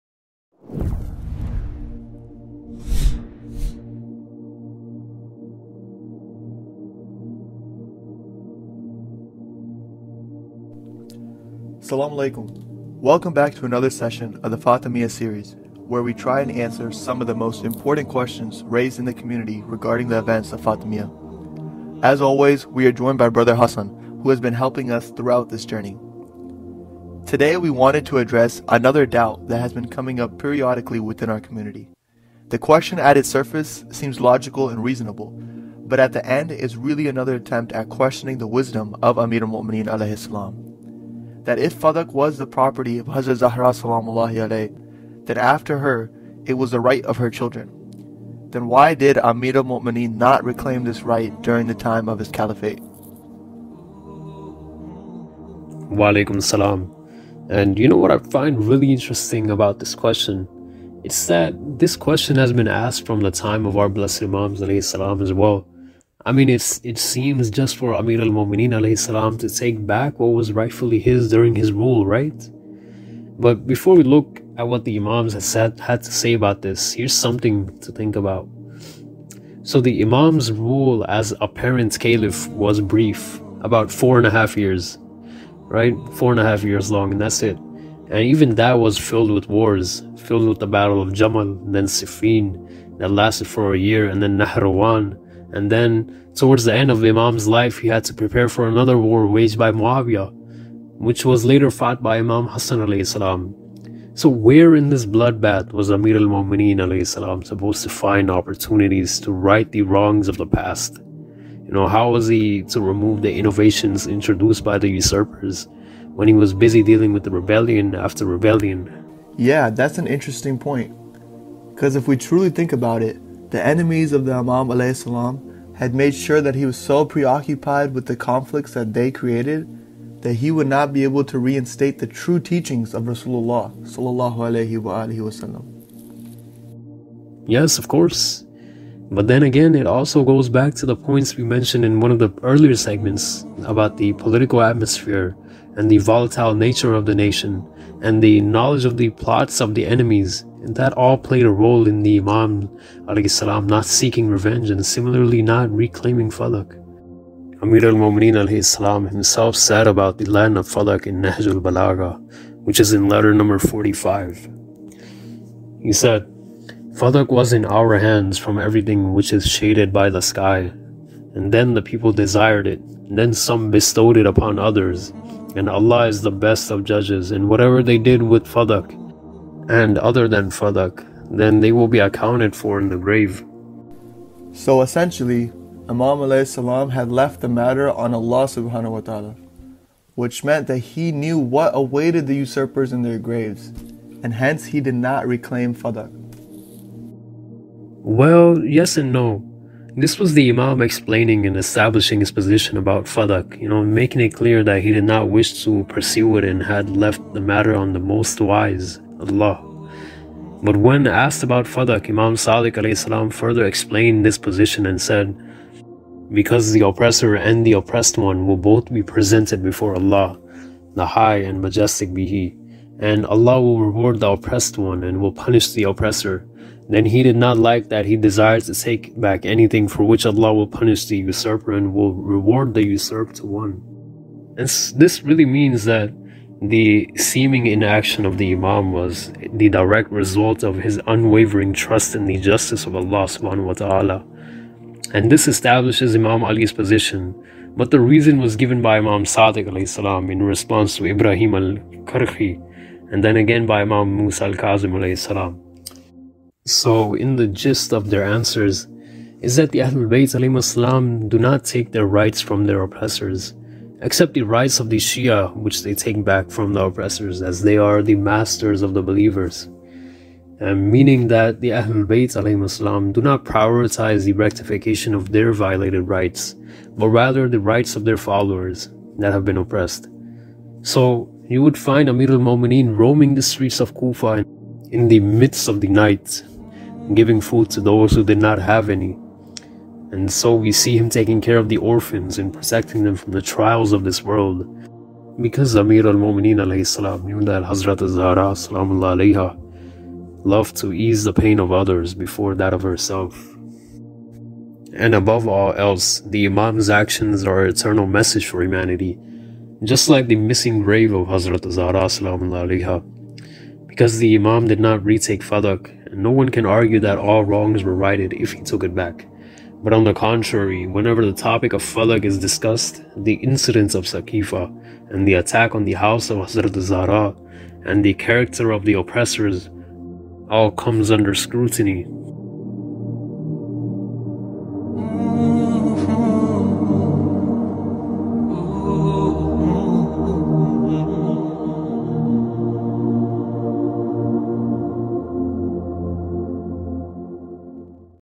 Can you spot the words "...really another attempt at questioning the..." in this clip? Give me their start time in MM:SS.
00:36.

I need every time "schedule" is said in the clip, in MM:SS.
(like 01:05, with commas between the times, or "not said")
not said.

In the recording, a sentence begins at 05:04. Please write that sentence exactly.
And above all else, the Imam's actions are an eternal message for humanity, just like the missing grave of Hazrat Zahra alayha.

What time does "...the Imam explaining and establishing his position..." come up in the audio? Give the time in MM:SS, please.
03:20.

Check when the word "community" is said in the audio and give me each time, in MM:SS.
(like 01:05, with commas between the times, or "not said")
00:19, 00:31.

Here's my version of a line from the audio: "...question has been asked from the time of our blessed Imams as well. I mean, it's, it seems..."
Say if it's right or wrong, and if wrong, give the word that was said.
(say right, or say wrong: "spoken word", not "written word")
right.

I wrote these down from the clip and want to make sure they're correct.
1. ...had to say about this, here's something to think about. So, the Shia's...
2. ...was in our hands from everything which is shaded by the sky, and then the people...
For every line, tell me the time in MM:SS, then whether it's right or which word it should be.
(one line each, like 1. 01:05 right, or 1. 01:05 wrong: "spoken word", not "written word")
1. 01:15 wrong: "Imam", not "Shia"
2. 02:47 right.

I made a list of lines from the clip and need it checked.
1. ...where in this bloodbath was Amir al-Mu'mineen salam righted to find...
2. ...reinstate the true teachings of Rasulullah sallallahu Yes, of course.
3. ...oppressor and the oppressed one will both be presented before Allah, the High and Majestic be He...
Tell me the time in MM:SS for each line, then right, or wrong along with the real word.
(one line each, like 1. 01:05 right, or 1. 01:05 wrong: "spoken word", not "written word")
1. 01:44 wrong: "supposed", not "righted"
2. 02:11 right
3. 03:36 right.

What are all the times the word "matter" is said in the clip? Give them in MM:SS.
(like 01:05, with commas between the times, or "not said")
03:07, 03:27.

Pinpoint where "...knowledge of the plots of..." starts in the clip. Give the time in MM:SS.
02:28.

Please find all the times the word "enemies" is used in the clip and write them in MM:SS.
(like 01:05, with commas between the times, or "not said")
02:03, 02:29.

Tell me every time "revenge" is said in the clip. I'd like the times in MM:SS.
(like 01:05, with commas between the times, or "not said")
02:34.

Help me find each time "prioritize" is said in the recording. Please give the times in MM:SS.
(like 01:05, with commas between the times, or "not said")
04:33.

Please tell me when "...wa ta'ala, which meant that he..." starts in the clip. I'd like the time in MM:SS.
03:08.